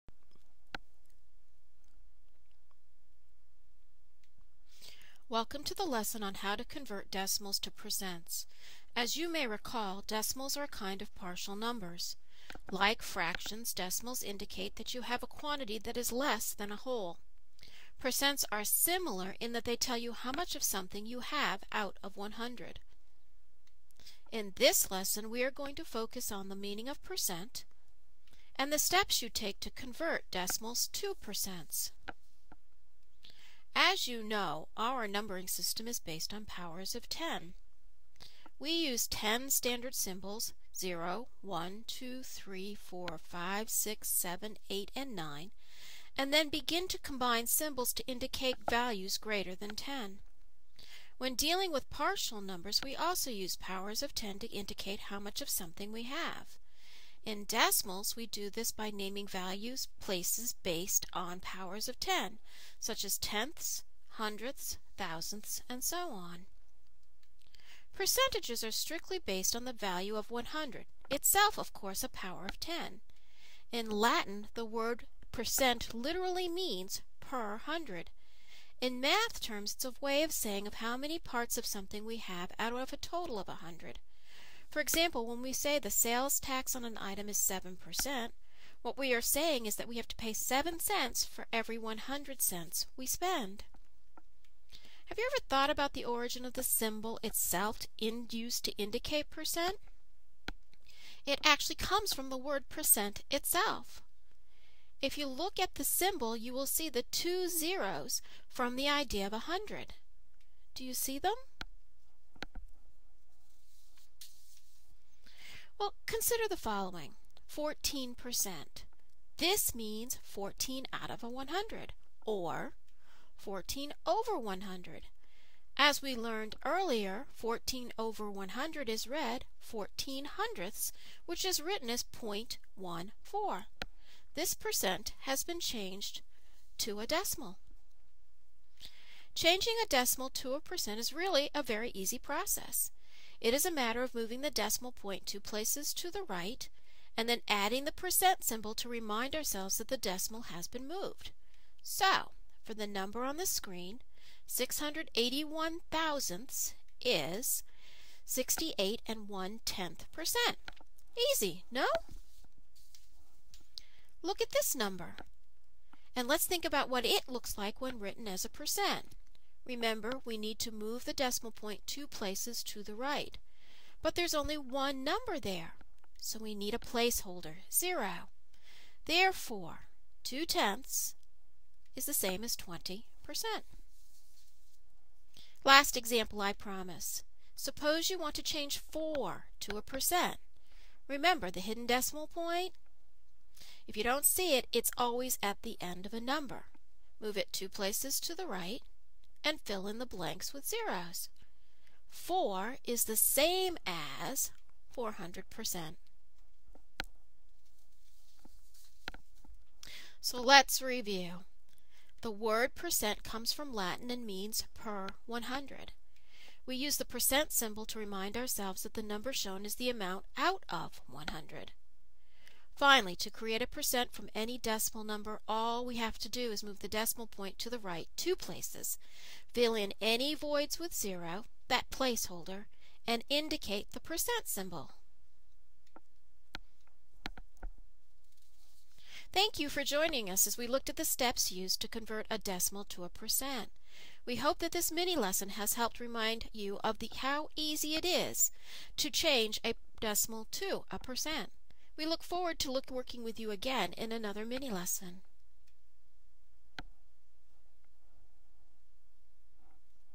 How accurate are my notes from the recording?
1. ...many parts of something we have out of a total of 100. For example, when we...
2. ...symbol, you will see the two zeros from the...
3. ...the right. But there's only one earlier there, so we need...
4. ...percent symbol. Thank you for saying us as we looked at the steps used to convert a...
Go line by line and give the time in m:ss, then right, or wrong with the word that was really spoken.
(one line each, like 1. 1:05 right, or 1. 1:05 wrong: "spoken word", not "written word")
1. 1:20 right
2. 1:45 right
3. 2:52 wrong: "number", not "earlier"
4. 3:53 wrong: "joining", not "saying".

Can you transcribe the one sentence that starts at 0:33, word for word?
As you know, our numbering system is based on powers of 10.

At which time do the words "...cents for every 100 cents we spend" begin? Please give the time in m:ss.
1:30.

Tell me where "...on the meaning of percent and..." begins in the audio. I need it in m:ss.
0:26.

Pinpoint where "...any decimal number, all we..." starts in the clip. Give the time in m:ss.
3:44.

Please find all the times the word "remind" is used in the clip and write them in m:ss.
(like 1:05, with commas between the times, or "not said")
2:28, 3:37, 4:05.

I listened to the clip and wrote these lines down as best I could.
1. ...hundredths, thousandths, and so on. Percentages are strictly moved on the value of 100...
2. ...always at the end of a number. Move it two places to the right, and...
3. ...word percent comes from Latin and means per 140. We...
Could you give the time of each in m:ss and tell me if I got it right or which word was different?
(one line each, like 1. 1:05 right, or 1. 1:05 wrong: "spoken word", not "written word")
1. 1:04 wrong: "based", not "moved"
2. 3:14 right
3. 3:32 wrong: "100", not "140".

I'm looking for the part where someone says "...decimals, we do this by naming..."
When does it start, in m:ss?
0:57.